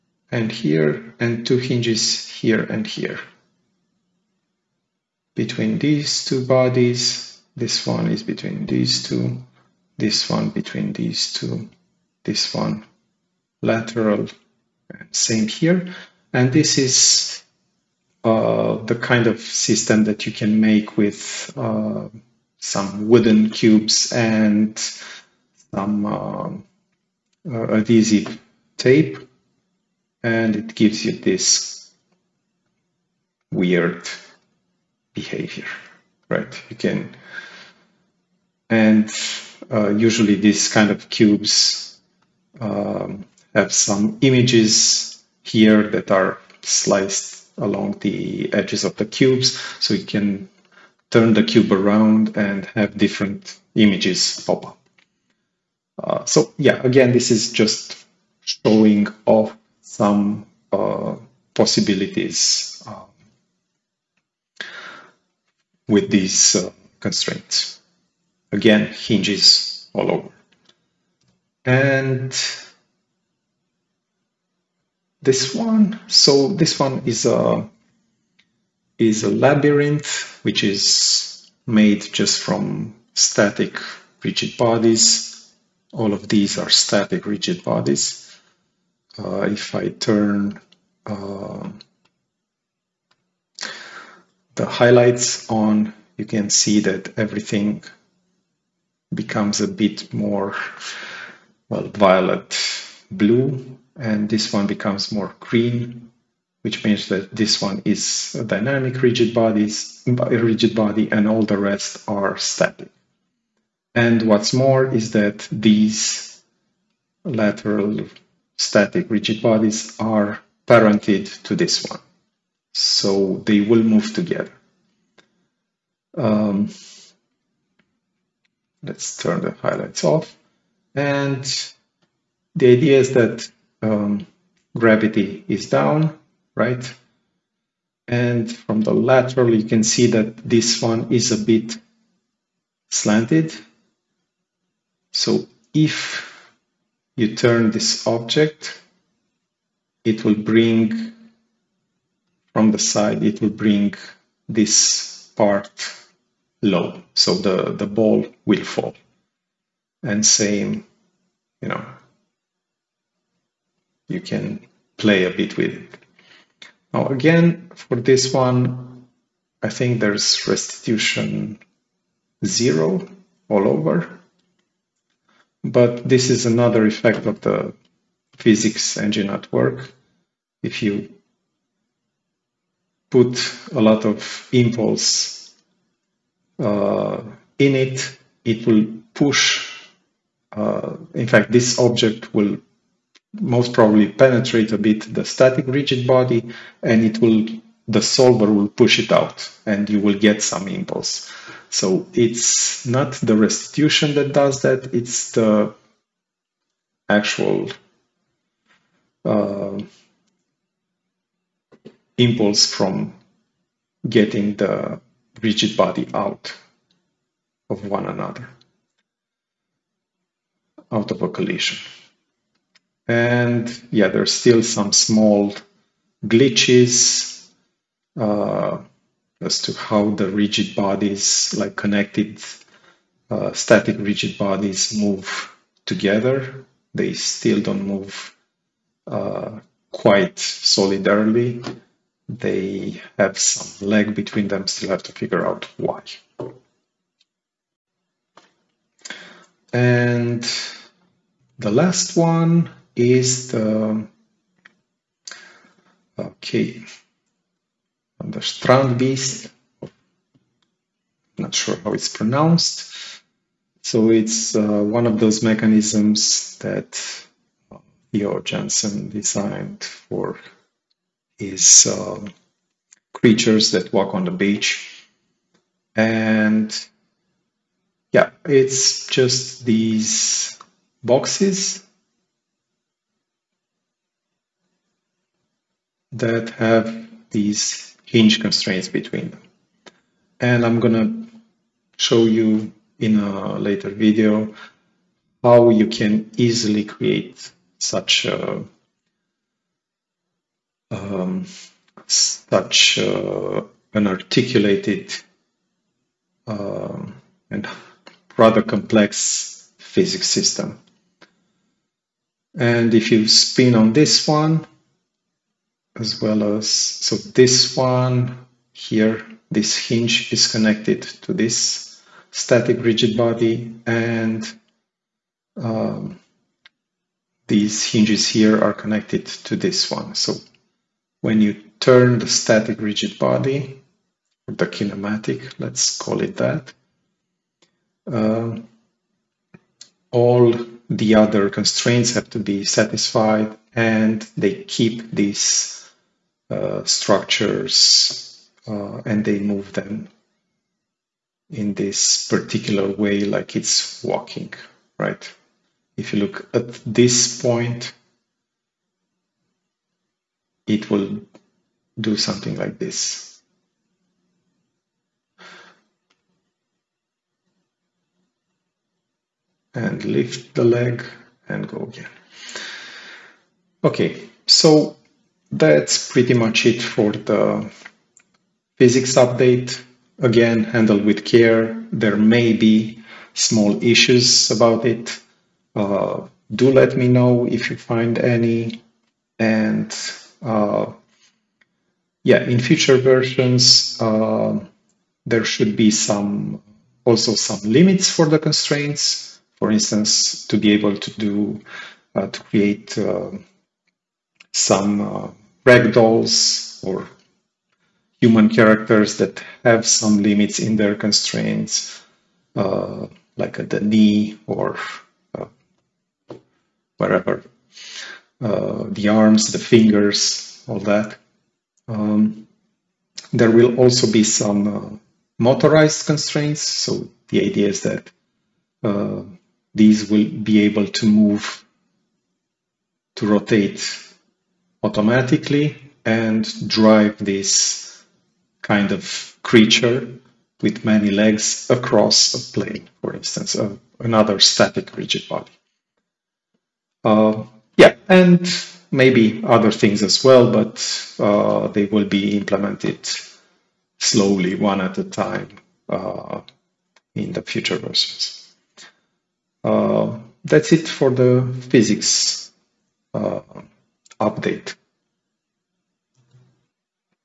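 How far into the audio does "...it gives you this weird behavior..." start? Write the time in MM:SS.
00:30.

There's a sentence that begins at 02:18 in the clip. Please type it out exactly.
And from the lateral, you can see that this one is a bit slanted.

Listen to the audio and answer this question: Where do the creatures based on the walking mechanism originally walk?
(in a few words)
On the beach.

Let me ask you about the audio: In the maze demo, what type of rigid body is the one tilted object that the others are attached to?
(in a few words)
Dynamic.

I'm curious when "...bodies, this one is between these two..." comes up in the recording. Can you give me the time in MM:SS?
00:06.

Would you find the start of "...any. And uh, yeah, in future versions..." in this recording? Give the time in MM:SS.
06:28.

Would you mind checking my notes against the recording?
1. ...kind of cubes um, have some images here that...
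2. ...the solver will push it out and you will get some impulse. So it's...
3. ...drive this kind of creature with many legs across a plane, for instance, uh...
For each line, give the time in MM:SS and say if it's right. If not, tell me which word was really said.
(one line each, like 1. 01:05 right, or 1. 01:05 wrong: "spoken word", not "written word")
1. 00:40 right
2. 03:17 right
3. 07:16 right.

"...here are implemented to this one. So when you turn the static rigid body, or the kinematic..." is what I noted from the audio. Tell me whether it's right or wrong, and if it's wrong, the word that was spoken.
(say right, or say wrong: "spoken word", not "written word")
wrong: "connected", not "implemented".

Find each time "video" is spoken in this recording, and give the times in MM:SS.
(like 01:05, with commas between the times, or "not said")
04:53.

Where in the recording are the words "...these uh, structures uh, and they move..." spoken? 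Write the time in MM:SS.
05:45.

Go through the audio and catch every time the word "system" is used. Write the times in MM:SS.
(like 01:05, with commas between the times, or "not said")
00:19, 05:10.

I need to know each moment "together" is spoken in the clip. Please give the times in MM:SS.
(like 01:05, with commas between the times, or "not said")
02:04, 03:55.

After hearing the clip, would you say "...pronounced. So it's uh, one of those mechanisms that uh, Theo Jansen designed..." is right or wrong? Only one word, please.
right.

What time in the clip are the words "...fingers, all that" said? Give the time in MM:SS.
06:59.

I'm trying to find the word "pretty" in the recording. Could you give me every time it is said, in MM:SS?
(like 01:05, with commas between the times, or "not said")
06:16.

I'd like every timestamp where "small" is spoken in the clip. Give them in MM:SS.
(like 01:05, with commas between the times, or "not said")
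03:44, 06:23.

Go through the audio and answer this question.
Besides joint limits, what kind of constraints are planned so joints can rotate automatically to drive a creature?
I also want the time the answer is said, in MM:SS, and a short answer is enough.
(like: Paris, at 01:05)
Motorized constraints, at 07:05.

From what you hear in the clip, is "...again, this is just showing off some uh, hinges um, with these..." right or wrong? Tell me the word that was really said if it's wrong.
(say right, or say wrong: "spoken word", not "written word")
wrong: "possibilities", not "hinges".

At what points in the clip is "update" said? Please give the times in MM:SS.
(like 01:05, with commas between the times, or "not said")
06:19, 07:44.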